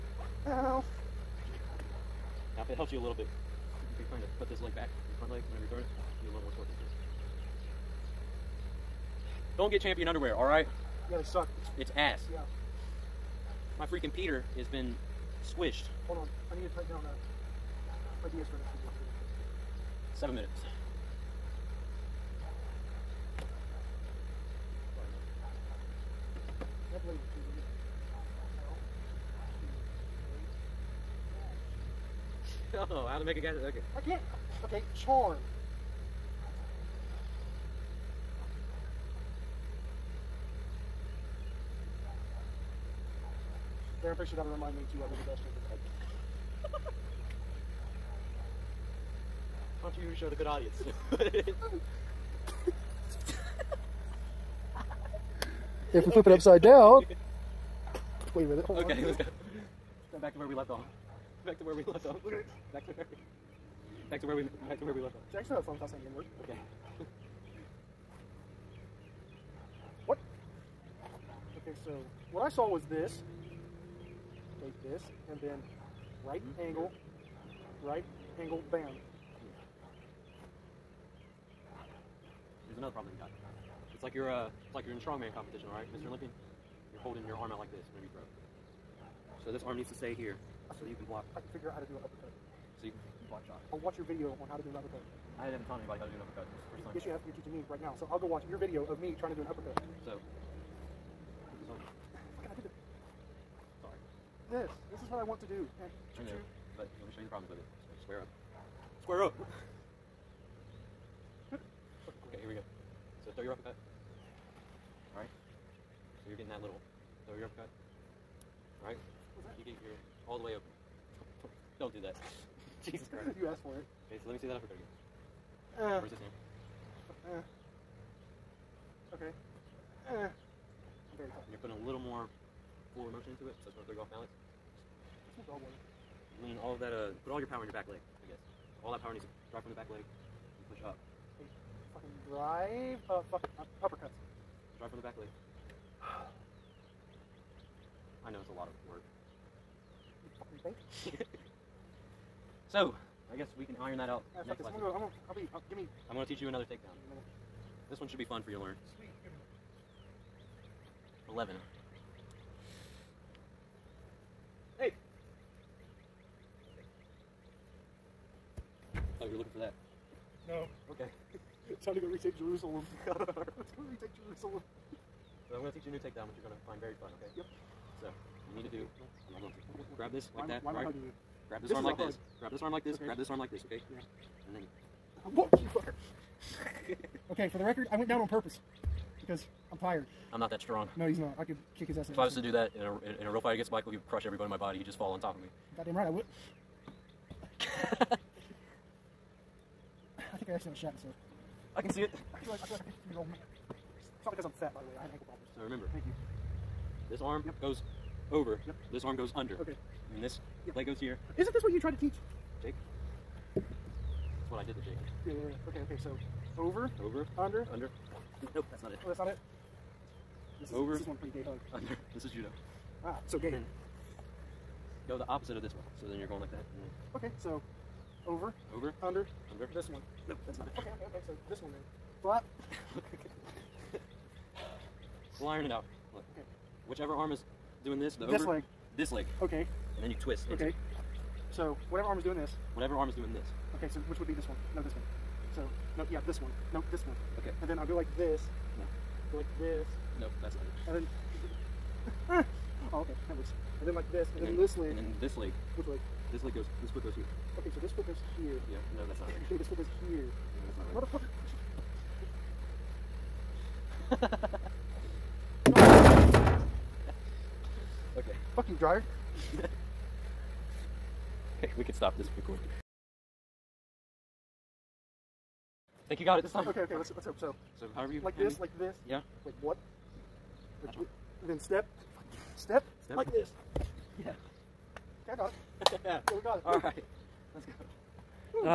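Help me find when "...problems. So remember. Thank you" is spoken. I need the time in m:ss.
3:25.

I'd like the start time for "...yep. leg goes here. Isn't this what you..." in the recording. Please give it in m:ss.
3:30.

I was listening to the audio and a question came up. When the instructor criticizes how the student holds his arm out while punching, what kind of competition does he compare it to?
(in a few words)
strongman competition.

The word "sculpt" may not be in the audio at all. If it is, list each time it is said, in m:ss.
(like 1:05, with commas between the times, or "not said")
not said.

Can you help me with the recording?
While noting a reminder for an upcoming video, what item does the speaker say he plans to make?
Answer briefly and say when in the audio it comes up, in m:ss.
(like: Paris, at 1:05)
gas changer, at 0:45.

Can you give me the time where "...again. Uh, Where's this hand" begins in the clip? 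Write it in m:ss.
2:04.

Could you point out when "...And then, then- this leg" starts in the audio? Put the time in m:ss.
4:14.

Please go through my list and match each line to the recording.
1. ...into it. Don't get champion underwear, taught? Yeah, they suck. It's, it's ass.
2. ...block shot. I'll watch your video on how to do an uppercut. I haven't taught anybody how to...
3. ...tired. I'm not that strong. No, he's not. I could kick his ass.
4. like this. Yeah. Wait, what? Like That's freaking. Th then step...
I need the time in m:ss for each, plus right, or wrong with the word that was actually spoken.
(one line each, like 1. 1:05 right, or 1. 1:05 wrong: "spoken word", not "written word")
1. 0:06 wrong: "alright", not "taught"
2. 1:33 right
3. 3:09 right
4. 4:38 wrong: "wrong", not "freaking".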